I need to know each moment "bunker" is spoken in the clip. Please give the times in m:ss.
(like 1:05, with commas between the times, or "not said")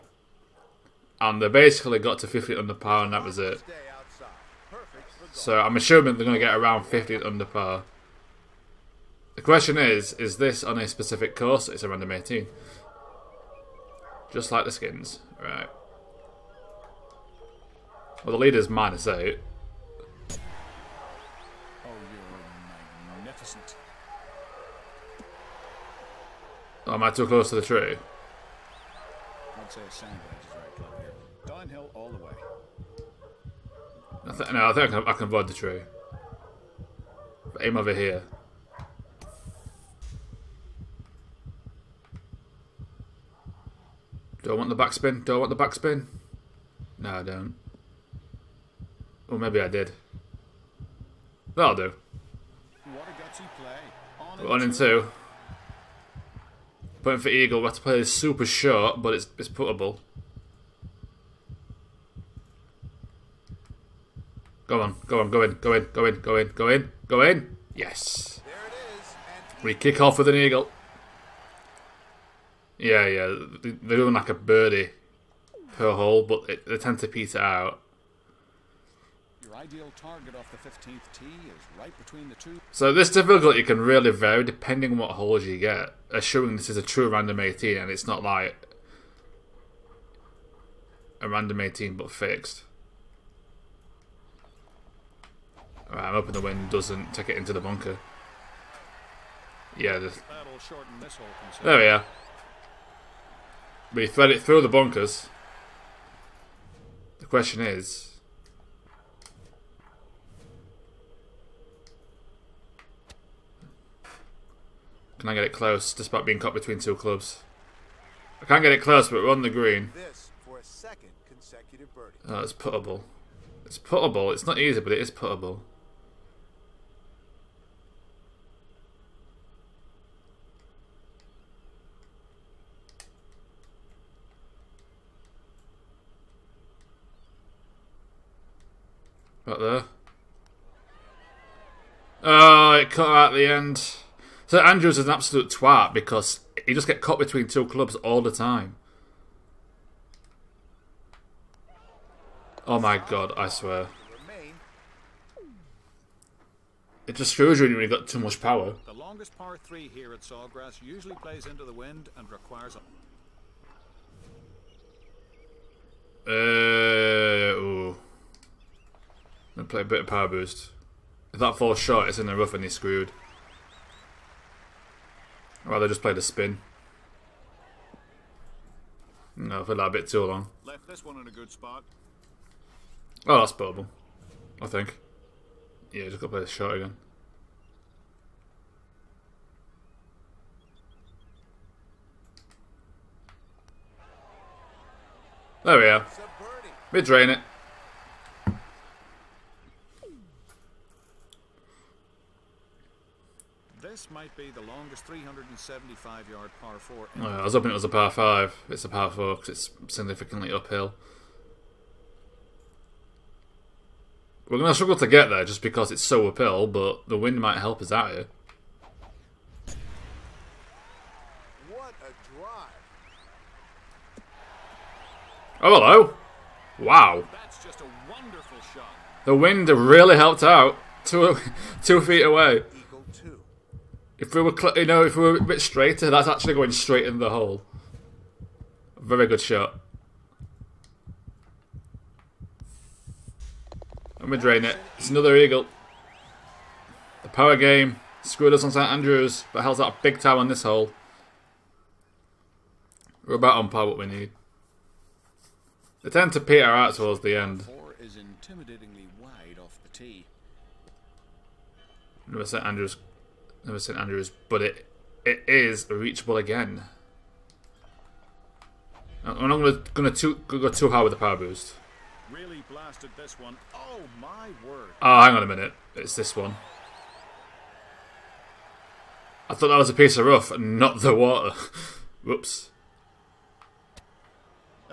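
1:37, 1:44.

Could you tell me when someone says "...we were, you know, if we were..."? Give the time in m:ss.
3:54.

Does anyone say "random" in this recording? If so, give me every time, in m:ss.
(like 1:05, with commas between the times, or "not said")
0:11, 1:27, 1:31.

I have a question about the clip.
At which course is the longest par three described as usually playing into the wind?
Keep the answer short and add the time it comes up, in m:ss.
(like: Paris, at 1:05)
Sawgrass, at 2:40.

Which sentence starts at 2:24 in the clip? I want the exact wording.
St Andrews is an absolute twat because he just get caught between two clubs all the time.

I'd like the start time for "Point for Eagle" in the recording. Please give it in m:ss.
0:57.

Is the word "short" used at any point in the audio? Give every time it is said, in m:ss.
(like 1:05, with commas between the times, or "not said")
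0:58, 2:51.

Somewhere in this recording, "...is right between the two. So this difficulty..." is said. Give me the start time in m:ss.
1:21.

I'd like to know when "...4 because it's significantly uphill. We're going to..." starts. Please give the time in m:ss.
3:29.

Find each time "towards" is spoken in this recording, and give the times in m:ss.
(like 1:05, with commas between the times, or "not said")
4:16.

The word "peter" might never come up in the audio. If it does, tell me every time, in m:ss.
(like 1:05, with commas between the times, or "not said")
1:17, 4:16.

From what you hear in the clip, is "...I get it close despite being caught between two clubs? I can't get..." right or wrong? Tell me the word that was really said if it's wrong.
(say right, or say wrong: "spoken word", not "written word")
right.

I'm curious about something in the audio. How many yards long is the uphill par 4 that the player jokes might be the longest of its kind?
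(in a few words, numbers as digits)
375 yards.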